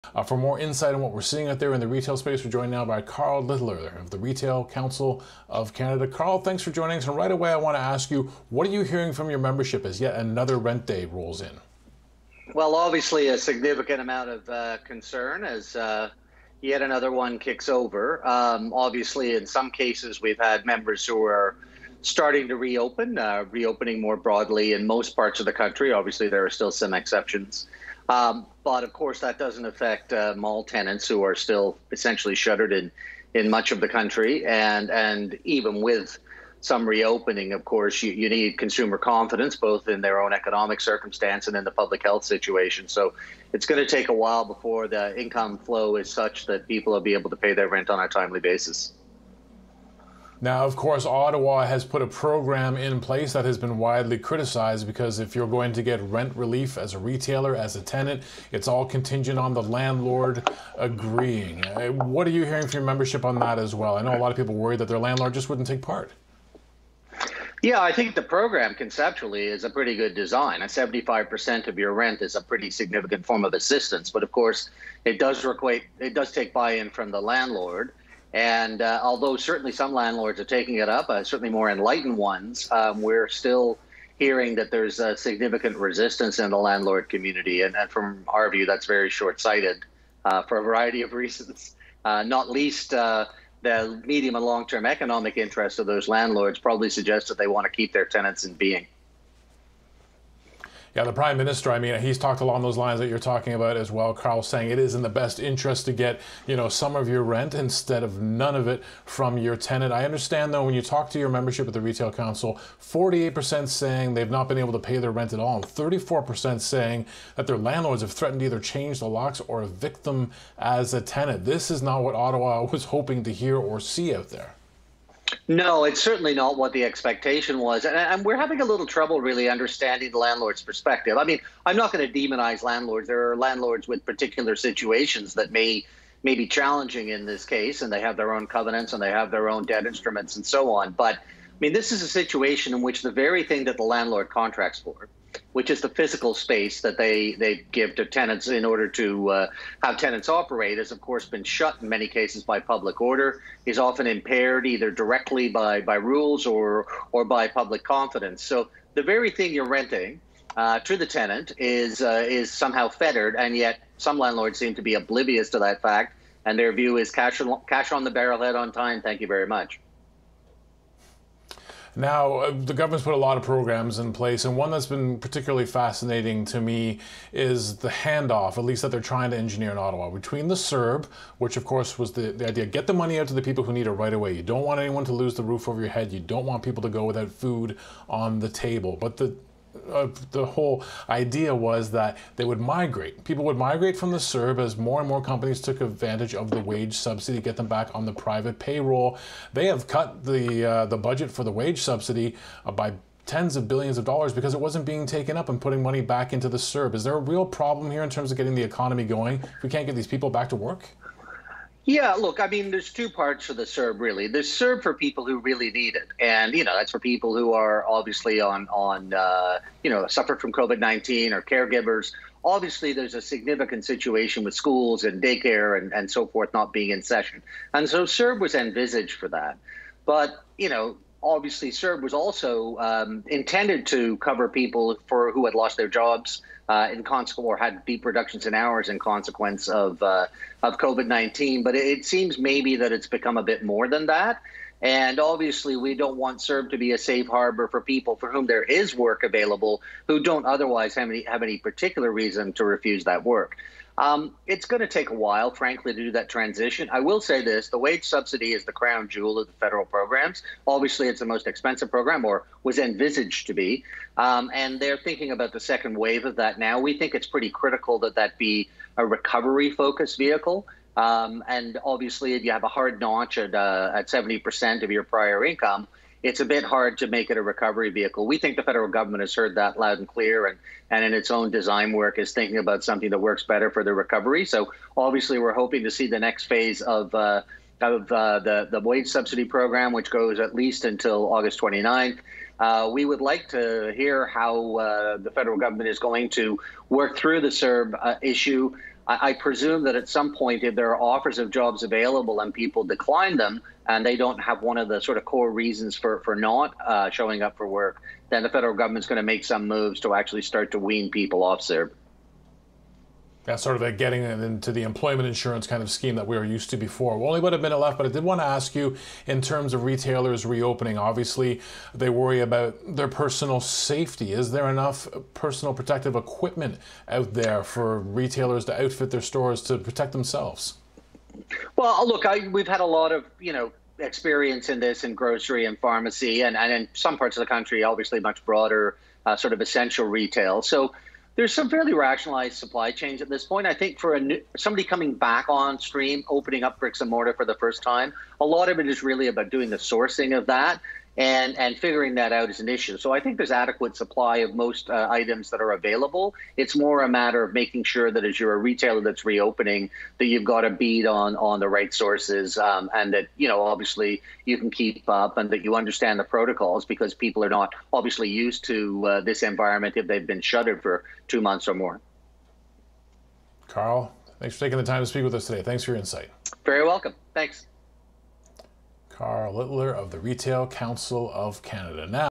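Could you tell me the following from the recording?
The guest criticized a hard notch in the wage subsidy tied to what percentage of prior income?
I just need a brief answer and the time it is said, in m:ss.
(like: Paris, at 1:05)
70%, at 4:34.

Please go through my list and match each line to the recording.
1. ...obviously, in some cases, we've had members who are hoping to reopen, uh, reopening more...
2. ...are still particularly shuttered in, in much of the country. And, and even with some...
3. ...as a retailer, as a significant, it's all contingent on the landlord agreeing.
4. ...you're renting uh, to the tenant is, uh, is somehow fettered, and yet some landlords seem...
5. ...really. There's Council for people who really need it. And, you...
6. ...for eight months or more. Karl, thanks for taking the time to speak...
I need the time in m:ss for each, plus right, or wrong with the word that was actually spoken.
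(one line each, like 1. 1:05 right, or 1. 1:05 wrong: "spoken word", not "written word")
1. 0:18 wrong: "starting", not "hoping"
2. 0:31 wrong: "essentially", not "particularly"
3. 0:56 wrong: "tenant", not "significant"
4. 2:39 right
5. 3:33 wrong: "CERB", not "Council"
6. 6:10 wrong: "two", not "eight".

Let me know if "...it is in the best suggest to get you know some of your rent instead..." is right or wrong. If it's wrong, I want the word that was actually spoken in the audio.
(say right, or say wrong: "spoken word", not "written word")
wrong: "interest", not "suggest".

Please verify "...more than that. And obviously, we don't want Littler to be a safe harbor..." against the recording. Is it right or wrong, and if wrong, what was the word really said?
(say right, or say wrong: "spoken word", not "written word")
wrong: "CERB", not "Littler".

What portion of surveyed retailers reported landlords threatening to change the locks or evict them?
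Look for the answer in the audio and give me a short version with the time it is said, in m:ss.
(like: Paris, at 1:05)
34%, at 1:55.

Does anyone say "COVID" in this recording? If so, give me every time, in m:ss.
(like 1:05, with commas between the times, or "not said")
3:40, 4:00.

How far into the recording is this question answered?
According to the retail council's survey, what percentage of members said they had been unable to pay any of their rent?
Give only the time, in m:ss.
1:52.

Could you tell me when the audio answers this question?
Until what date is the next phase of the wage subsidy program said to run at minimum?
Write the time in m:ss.
4:51.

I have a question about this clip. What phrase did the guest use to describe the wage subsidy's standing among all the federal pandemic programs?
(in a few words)
crown jewel.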